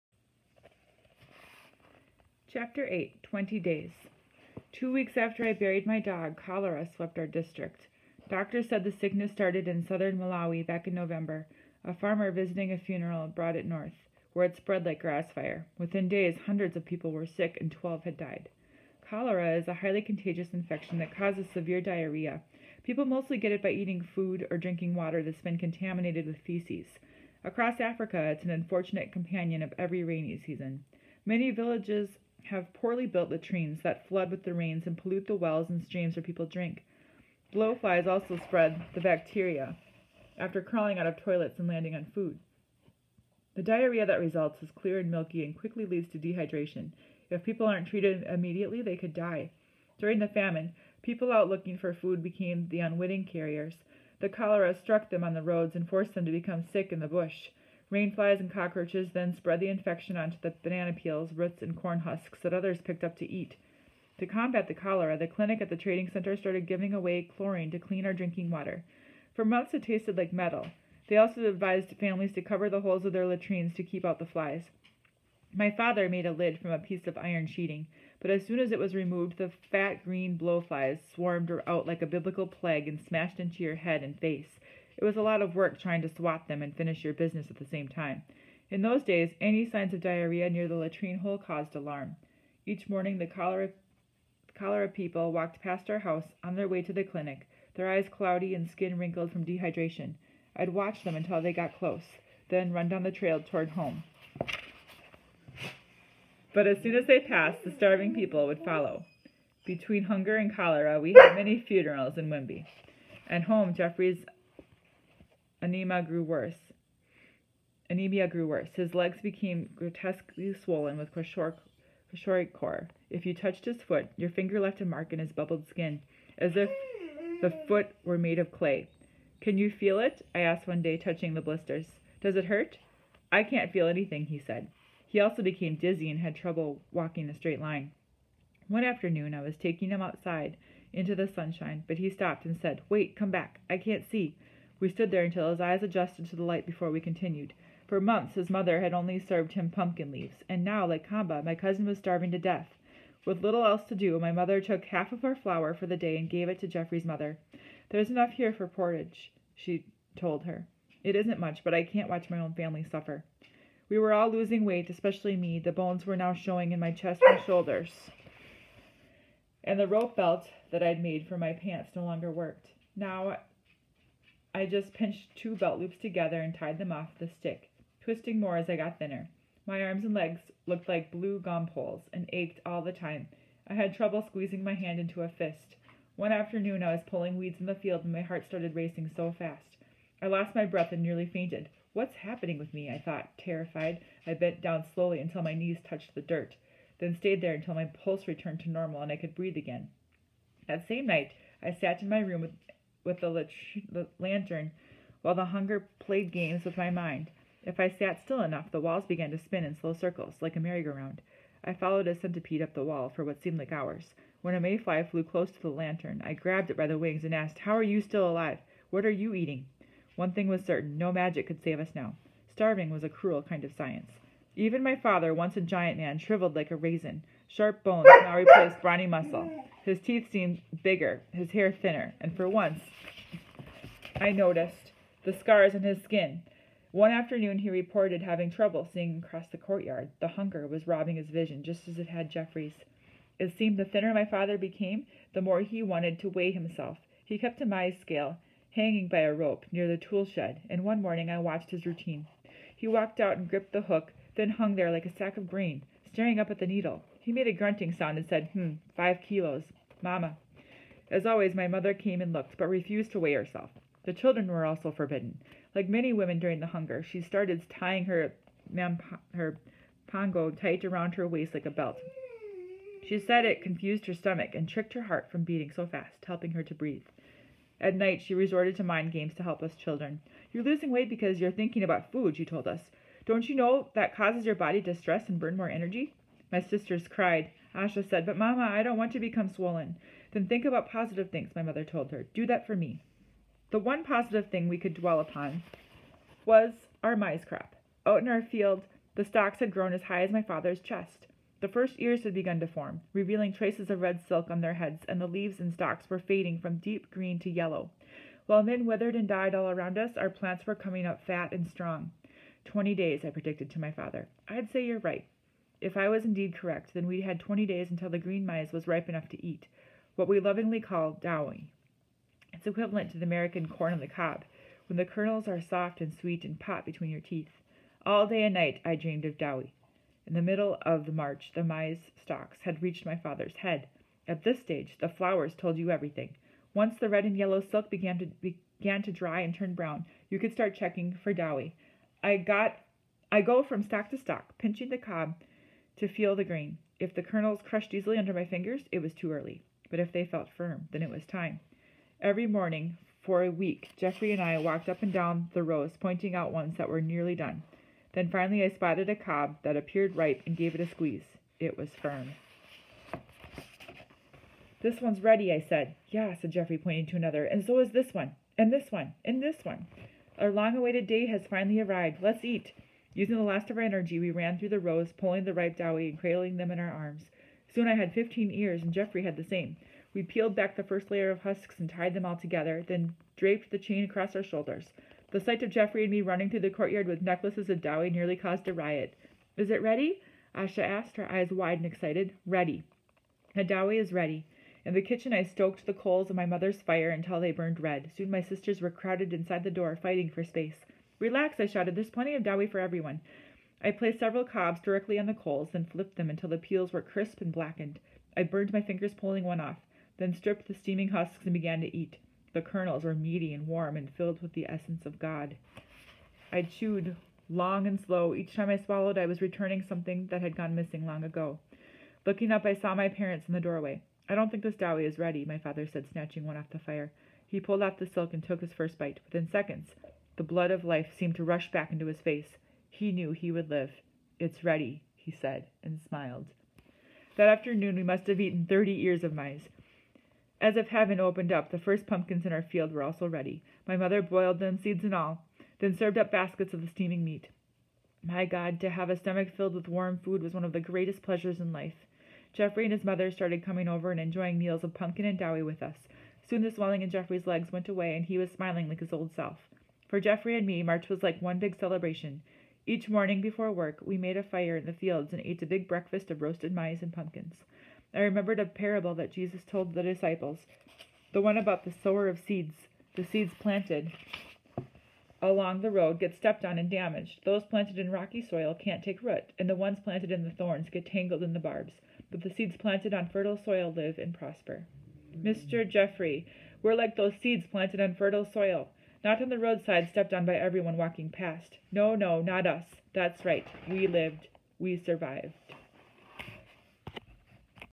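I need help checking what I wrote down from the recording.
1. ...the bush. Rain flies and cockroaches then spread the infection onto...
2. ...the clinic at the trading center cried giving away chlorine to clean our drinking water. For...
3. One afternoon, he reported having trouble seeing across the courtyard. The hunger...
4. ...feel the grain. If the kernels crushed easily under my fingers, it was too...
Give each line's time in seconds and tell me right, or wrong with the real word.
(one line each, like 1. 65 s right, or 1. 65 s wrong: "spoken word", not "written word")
1. 56 s right
2. 65 s wrong: "started", not "cried"
3. 236 s right
4. 346 s right.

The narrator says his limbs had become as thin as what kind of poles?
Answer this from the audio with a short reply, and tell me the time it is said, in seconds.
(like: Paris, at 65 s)
blue gum poles, at 181 s.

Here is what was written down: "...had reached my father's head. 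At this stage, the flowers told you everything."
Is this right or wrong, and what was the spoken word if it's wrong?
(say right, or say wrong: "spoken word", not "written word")
right.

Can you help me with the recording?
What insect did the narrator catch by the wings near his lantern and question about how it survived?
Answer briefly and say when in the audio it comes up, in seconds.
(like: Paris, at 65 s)
mayfly, at 214 s.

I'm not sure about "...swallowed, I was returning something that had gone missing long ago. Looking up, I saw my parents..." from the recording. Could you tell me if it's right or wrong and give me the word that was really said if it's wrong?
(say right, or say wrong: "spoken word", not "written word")
right.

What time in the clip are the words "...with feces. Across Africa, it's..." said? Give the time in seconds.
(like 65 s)
26 s.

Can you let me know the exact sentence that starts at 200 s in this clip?
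That same night, I sat in my room with with the, the lantern while the hunger played games with my mind.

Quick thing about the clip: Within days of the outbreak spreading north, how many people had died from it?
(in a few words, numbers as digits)
12.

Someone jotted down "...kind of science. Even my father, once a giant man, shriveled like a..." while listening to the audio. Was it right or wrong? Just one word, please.
right.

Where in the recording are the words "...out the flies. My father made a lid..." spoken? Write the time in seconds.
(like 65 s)
74 s.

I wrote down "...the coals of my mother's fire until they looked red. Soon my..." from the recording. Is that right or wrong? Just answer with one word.
wrong.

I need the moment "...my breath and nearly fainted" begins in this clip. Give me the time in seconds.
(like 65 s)
190 s.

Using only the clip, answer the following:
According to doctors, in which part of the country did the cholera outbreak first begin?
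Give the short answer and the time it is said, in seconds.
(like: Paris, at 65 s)
southern Malawi, at 9 s.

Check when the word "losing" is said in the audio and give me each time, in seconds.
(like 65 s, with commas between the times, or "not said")
164 s, 280 s.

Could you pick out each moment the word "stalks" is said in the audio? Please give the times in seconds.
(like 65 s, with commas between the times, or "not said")
299 s, 305 s, 332 s.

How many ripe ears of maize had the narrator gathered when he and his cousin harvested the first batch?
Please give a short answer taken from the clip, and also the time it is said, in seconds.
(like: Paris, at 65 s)
15, at 378 s.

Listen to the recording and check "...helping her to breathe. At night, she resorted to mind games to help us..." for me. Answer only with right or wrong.
right.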